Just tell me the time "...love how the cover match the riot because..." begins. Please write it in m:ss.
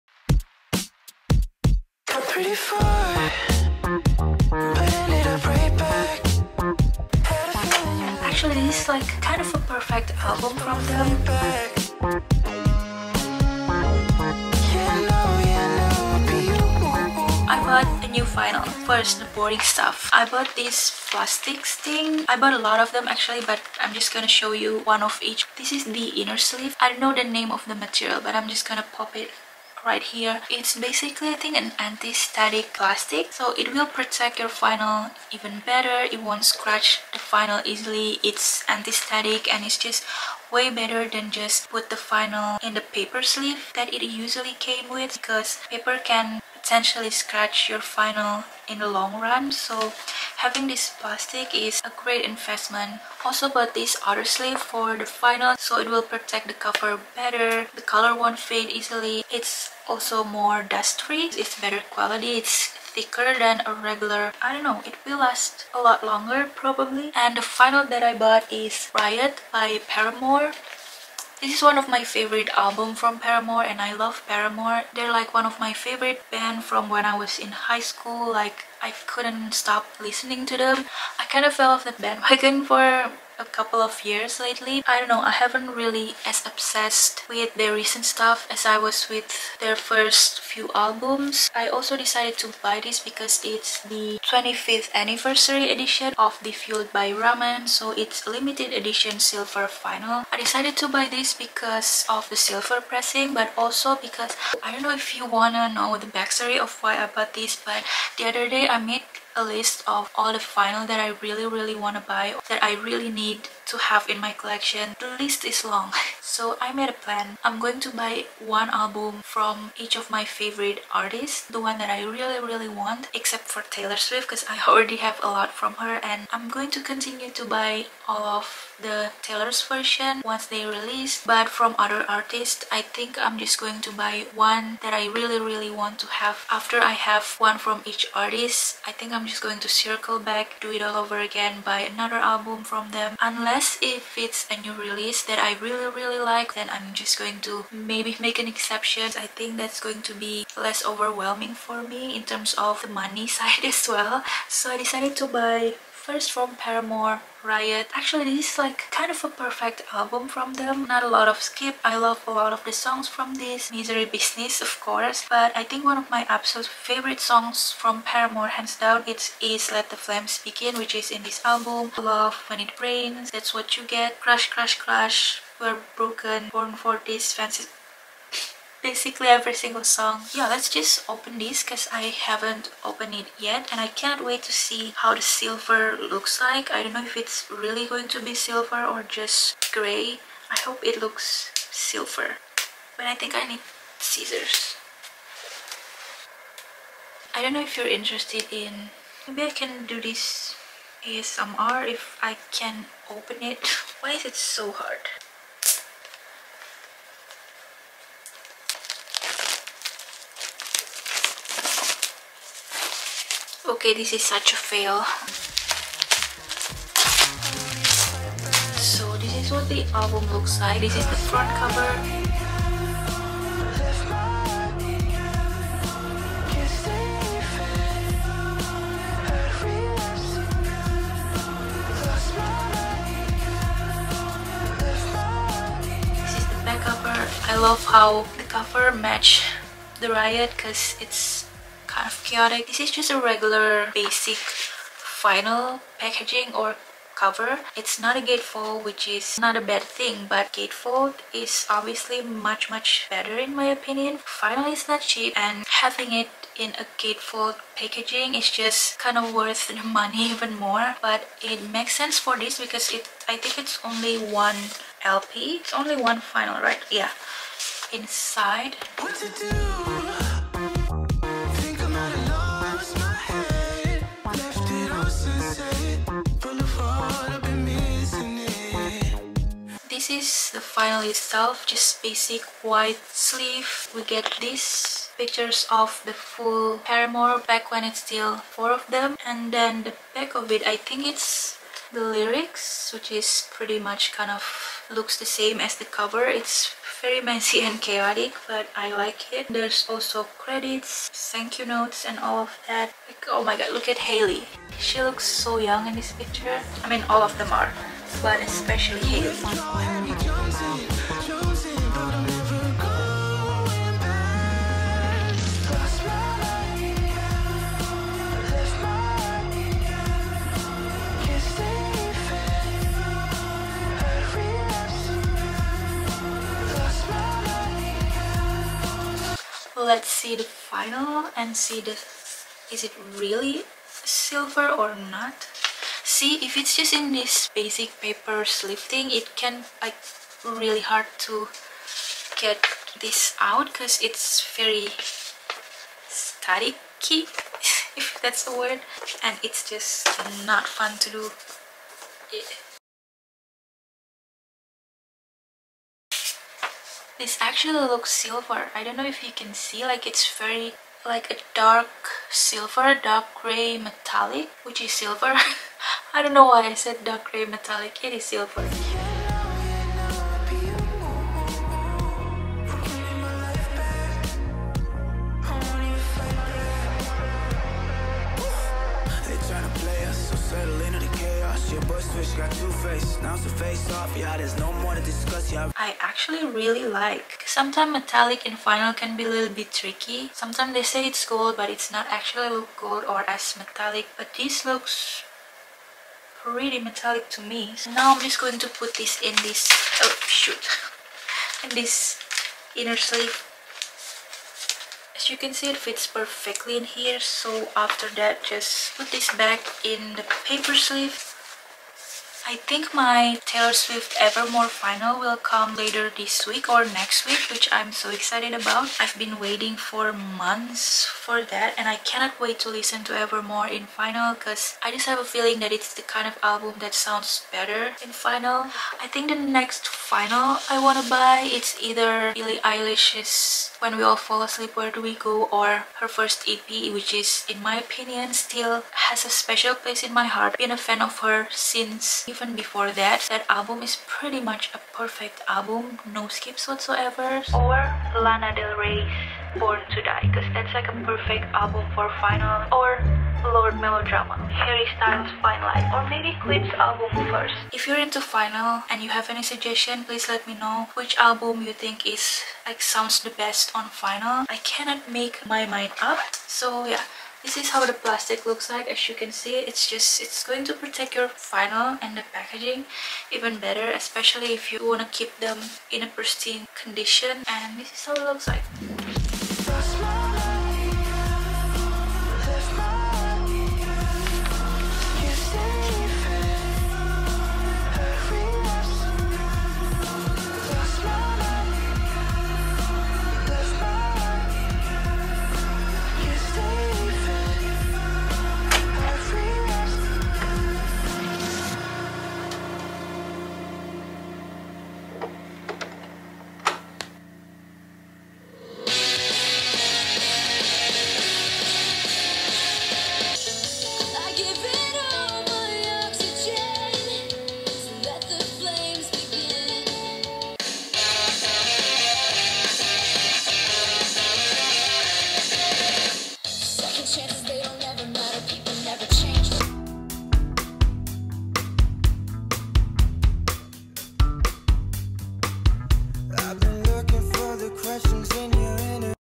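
3:57.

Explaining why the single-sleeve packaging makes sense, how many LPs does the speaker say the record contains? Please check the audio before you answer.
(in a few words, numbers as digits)
1.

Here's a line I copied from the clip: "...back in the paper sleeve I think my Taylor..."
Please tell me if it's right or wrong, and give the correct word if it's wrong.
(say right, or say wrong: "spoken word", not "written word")
right.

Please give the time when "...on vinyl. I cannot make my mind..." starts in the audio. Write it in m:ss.
7:43.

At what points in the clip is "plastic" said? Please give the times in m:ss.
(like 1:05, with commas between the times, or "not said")
0:21, 0:32, 0:50, 7:47.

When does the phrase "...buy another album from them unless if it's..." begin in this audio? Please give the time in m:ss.
2:21.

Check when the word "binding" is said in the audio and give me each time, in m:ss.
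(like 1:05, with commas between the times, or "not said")
not said.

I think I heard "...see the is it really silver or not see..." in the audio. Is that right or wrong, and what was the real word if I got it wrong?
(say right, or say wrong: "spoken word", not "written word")
right.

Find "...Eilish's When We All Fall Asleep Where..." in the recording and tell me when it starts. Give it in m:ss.
7:12.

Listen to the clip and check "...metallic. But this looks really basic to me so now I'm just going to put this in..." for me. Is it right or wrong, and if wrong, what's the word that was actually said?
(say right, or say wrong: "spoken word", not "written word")
wrong: "metallic", not "basic".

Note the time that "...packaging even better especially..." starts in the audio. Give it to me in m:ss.
7:52.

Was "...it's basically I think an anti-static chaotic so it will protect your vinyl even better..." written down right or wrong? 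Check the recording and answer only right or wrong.
wrong.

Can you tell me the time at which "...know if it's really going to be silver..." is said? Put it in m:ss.
3:06.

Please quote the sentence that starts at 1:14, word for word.
They're like one of my favorite band from when I was in high school.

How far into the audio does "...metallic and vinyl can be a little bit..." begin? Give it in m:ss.
6:27.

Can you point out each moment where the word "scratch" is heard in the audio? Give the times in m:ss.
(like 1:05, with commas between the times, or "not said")
0:36, 0:47.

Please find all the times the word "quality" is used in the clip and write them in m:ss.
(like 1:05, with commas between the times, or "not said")
1:01.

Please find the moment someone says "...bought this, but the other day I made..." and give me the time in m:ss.
1:47.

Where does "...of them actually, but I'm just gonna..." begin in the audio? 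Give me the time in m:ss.
0:22.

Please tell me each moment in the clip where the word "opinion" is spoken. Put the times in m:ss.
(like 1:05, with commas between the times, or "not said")
4:13, 7:17.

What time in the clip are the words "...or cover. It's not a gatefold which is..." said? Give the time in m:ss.
4:06.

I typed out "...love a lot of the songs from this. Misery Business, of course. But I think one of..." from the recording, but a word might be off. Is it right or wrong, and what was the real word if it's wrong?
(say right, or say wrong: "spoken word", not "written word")
right.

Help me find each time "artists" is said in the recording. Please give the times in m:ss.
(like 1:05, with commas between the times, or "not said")
2:00, 2:12, 2:18.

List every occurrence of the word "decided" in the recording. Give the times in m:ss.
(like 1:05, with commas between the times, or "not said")
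1:31, 1:40, 2:34.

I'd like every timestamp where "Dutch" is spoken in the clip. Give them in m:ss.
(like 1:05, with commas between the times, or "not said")
not said.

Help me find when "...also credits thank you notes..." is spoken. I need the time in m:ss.
4:59.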